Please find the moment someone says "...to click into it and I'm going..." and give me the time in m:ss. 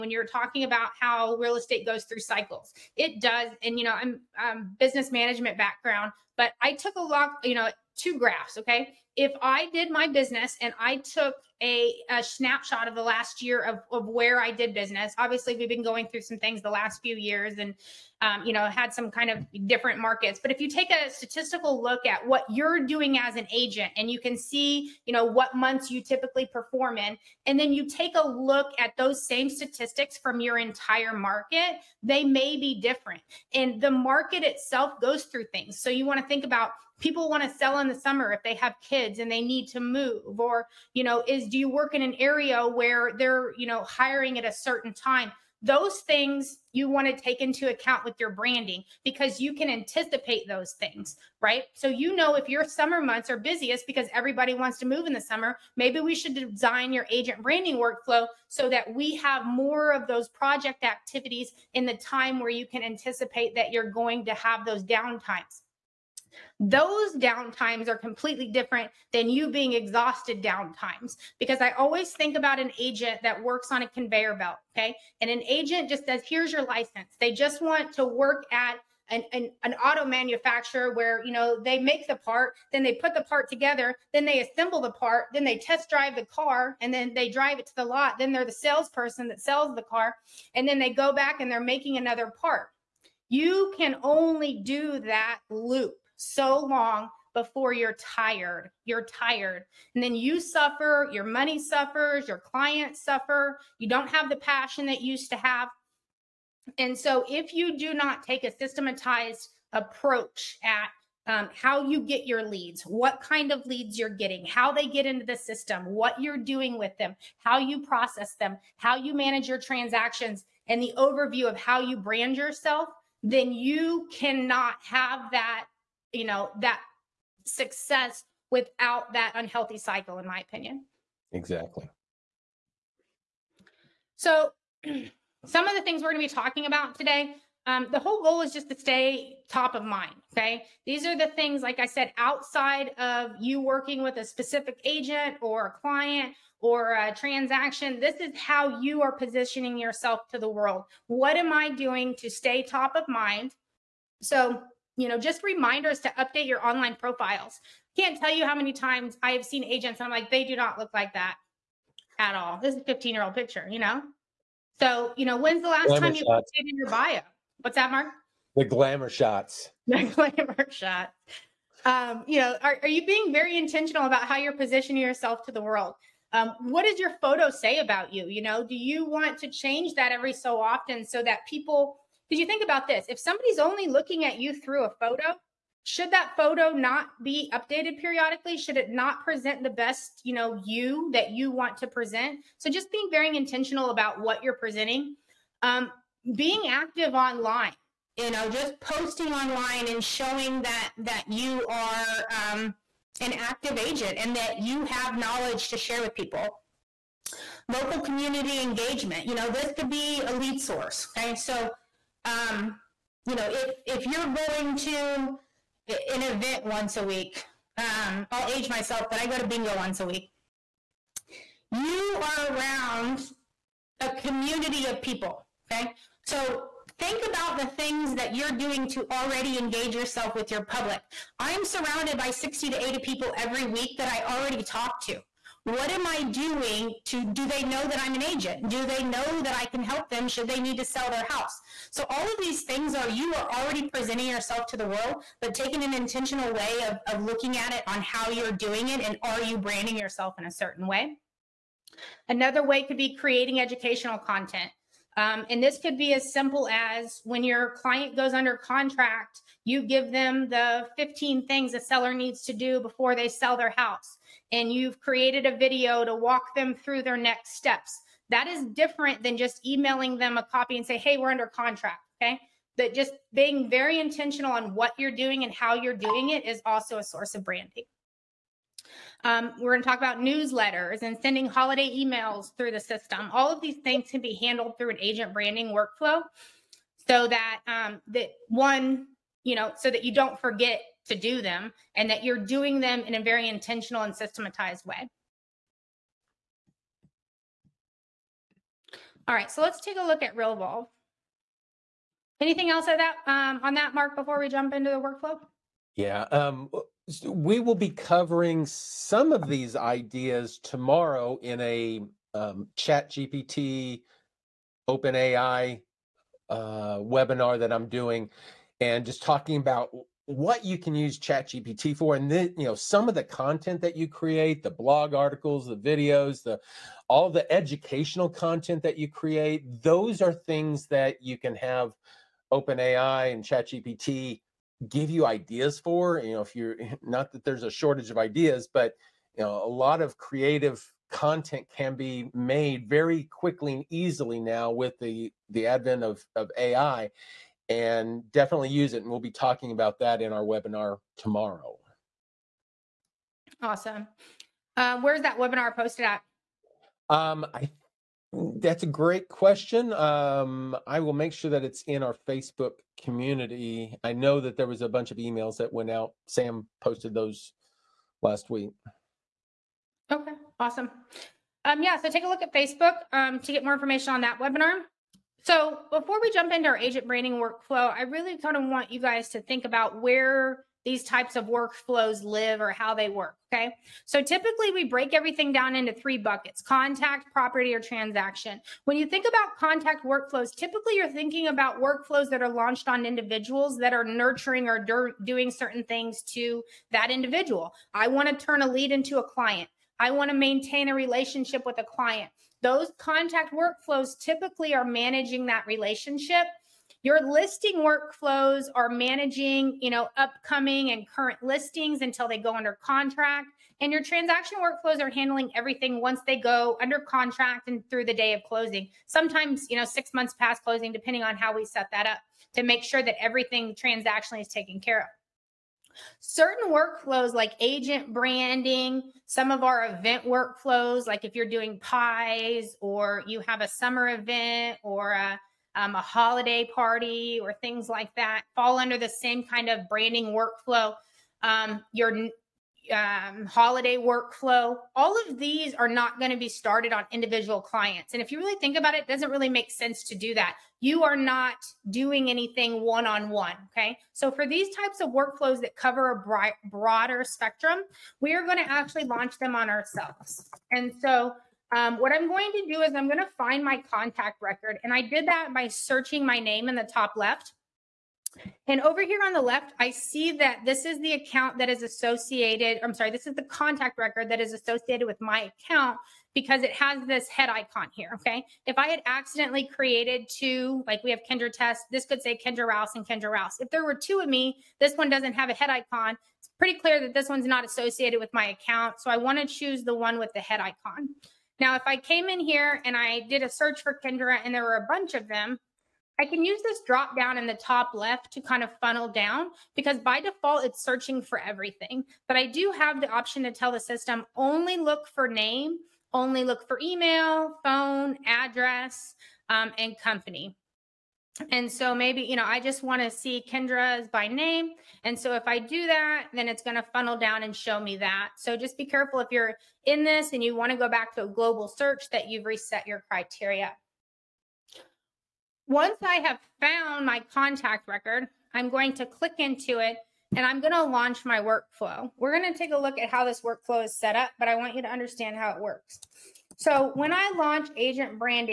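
8:48.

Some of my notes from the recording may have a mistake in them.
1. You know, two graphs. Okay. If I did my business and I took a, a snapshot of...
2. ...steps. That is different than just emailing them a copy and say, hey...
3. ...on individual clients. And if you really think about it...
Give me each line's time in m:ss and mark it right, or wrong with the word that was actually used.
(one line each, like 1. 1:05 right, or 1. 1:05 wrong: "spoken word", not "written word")
1. 0:07 right
2. 4:27 right
3. 7:26 right.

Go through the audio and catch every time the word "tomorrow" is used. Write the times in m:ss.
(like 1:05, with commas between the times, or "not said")
5:10, 5:51.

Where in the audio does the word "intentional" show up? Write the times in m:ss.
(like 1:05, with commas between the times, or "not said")
2:53, 3:13, 4:05, 4:33, 4:53.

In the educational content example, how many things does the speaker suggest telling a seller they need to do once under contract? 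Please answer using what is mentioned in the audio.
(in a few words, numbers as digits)
15.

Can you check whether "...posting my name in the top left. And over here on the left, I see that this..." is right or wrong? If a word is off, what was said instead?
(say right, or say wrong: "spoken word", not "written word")
wrong: "searching", not "posting".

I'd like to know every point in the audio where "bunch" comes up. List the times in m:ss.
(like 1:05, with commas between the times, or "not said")
6:04, 8:14.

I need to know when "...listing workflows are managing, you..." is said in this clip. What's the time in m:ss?
6:47.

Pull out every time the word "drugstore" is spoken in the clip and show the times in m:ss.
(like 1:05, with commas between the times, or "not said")
not said.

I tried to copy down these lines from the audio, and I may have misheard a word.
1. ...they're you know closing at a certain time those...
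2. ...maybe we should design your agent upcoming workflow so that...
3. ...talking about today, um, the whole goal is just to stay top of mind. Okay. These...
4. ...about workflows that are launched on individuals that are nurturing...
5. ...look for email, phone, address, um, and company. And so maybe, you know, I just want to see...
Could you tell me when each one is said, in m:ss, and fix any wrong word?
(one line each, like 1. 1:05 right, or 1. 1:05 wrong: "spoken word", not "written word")
1. 0:43 wrong: "hiring", not "closing"
2. 0:55 wrong: "branding", not "upcoming"
3. 2:16 right
4. 6:31 right
5. 8:26 right.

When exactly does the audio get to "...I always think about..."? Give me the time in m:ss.
1:11.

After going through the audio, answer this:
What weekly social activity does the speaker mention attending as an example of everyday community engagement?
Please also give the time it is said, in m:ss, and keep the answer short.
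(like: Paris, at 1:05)
bingo, at 3:39.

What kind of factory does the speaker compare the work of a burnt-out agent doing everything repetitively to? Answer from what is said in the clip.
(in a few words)
auto manufacturer.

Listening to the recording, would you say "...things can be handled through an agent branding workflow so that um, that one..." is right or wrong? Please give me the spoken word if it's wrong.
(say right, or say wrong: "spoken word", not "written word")
right.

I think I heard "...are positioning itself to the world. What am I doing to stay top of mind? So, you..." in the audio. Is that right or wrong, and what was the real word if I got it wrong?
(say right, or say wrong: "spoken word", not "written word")
wrong: "yourself", not "itself".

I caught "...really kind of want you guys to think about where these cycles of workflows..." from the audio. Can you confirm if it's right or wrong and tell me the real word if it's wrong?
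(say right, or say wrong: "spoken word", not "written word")
wrong: "types", not "cycles".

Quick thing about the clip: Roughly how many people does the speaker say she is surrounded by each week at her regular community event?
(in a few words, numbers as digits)
60 to 80.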